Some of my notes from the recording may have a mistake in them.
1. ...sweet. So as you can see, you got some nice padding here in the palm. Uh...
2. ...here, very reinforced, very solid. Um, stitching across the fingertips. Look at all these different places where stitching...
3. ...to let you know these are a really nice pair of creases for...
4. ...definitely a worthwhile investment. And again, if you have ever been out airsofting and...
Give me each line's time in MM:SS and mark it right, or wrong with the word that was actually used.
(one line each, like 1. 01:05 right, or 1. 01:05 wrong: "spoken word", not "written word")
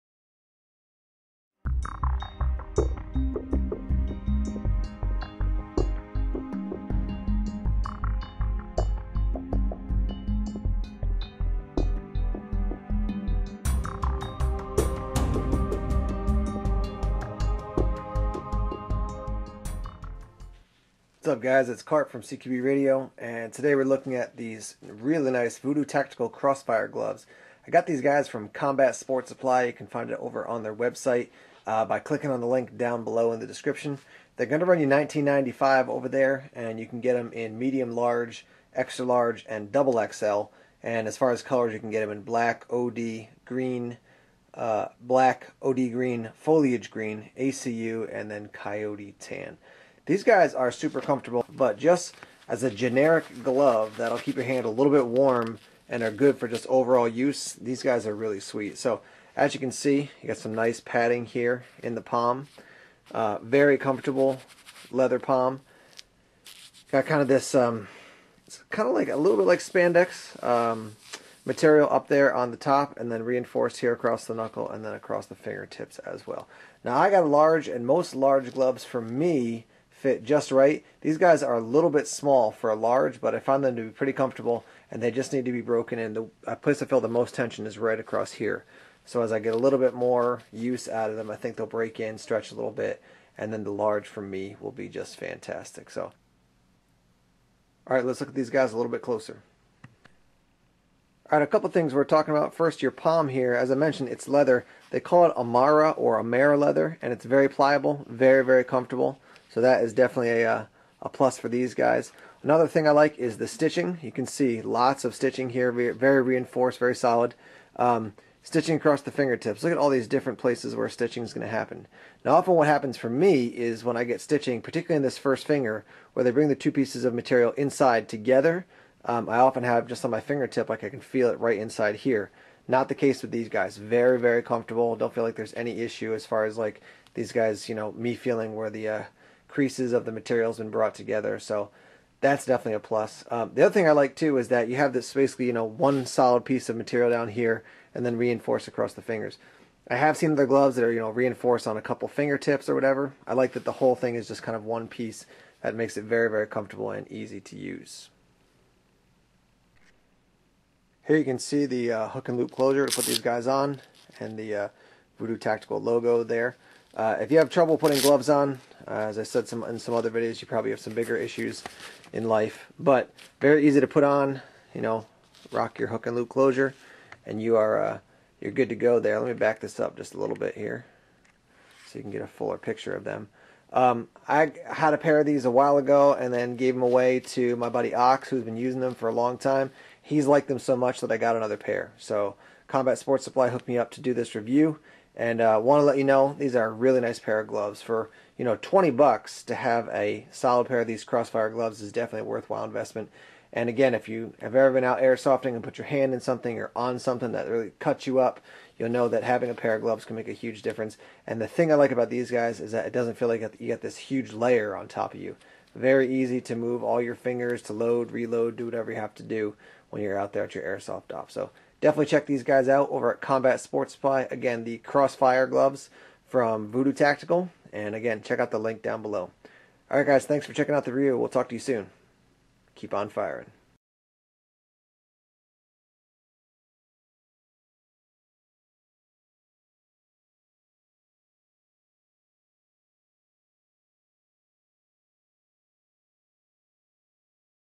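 1. 00:58 right
2. 01:55 right
3. 03:15 wrong: "gloves", not "creases"
4. 03:21 right.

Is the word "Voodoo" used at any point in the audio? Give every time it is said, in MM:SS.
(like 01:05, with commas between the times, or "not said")
00:25, 02:45, 03:46.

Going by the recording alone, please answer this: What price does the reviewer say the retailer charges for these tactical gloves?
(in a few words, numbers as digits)
$19.95.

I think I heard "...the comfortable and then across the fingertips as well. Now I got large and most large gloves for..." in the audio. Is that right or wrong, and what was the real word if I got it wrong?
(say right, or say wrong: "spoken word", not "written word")
wrong: "knuckle", not "comfortable".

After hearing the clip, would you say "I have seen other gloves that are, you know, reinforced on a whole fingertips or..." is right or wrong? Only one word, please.
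wrong.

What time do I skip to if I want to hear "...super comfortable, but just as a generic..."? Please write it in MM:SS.
00:50.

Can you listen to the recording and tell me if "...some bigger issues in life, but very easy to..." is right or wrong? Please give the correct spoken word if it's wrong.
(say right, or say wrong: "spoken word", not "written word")
right.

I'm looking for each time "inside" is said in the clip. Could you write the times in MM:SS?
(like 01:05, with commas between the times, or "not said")
02:07, 02:11.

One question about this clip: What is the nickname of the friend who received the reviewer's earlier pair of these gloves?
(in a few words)
Ox.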